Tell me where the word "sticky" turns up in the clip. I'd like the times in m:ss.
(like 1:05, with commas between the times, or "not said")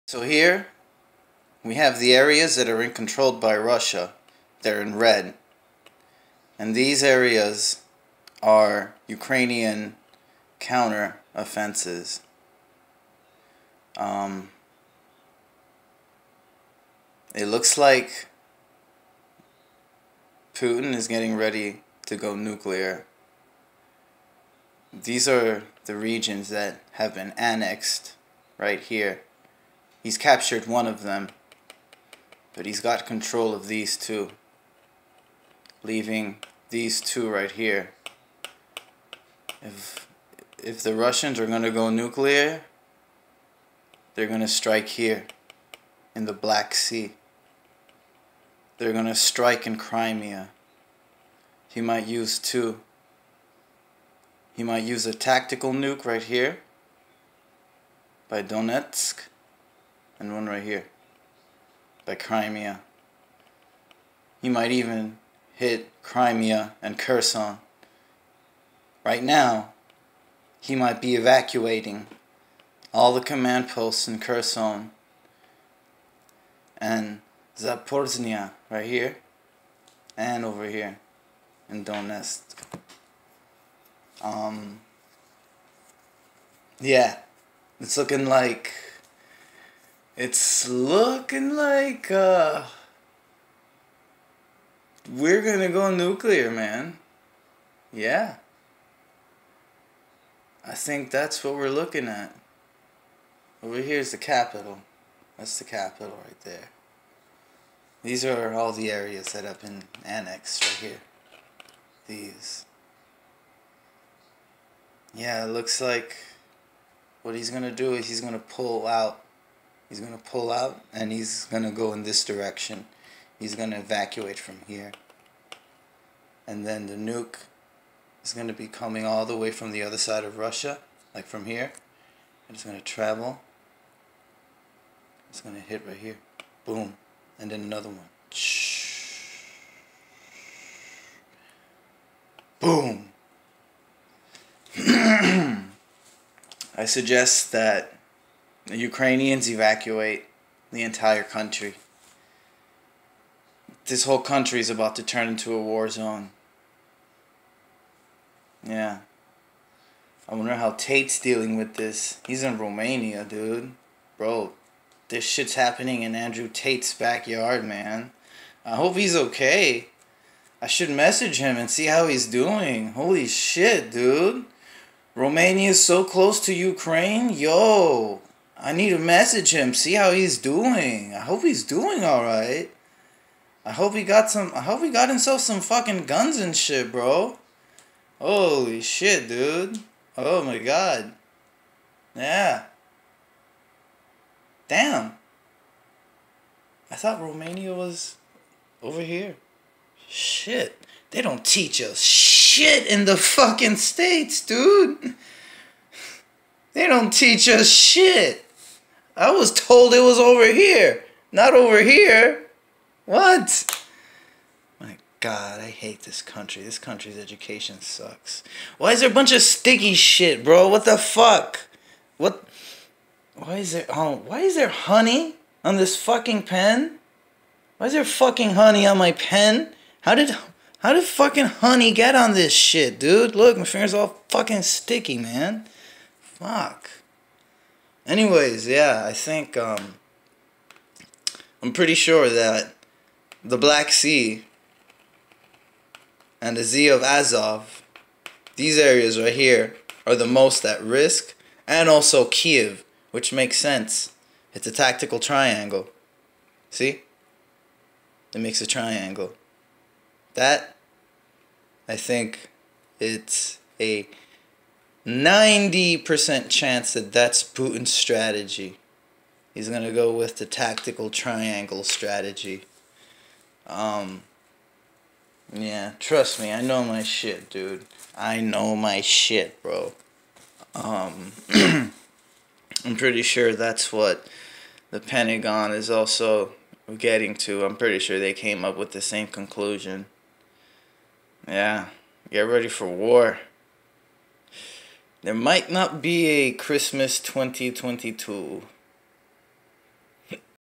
3:39, 3:54.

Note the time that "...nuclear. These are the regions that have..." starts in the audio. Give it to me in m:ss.
0:22.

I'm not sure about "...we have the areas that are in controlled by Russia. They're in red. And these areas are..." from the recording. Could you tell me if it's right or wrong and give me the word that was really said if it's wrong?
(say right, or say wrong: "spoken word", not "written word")
right.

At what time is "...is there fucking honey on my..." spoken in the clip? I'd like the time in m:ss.
3:47.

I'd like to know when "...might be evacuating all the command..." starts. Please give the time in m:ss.
1:10.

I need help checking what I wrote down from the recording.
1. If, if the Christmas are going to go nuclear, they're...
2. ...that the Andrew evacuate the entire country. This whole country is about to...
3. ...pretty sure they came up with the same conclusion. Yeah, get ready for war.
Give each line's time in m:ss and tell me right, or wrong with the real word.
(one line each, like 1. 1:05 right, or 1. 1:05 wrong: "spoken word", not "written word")
1. 0:39 wrong: "Russians", not "Christmas"
2. 2:27 wrong: "Ukrainians", not "Andrew"
3. 4:47 right.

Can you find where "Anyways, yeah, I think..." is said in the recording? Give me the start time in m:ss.
3:58.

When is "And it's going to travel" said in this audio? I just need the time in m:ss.
2:12.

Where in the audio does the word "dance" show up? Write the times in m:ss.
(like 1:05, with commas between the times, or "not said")
not said.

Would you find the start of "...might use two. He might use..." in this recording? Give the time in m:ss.
0:51.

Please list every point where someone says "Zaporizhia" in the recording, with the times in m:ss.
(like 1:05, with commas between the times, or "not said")
1:17.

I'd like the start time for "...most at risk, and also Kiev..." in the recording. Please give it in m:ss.
4:10.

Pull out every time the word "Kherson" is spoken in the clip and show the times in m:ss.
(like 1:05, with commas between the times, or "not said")
1:06, 1:14.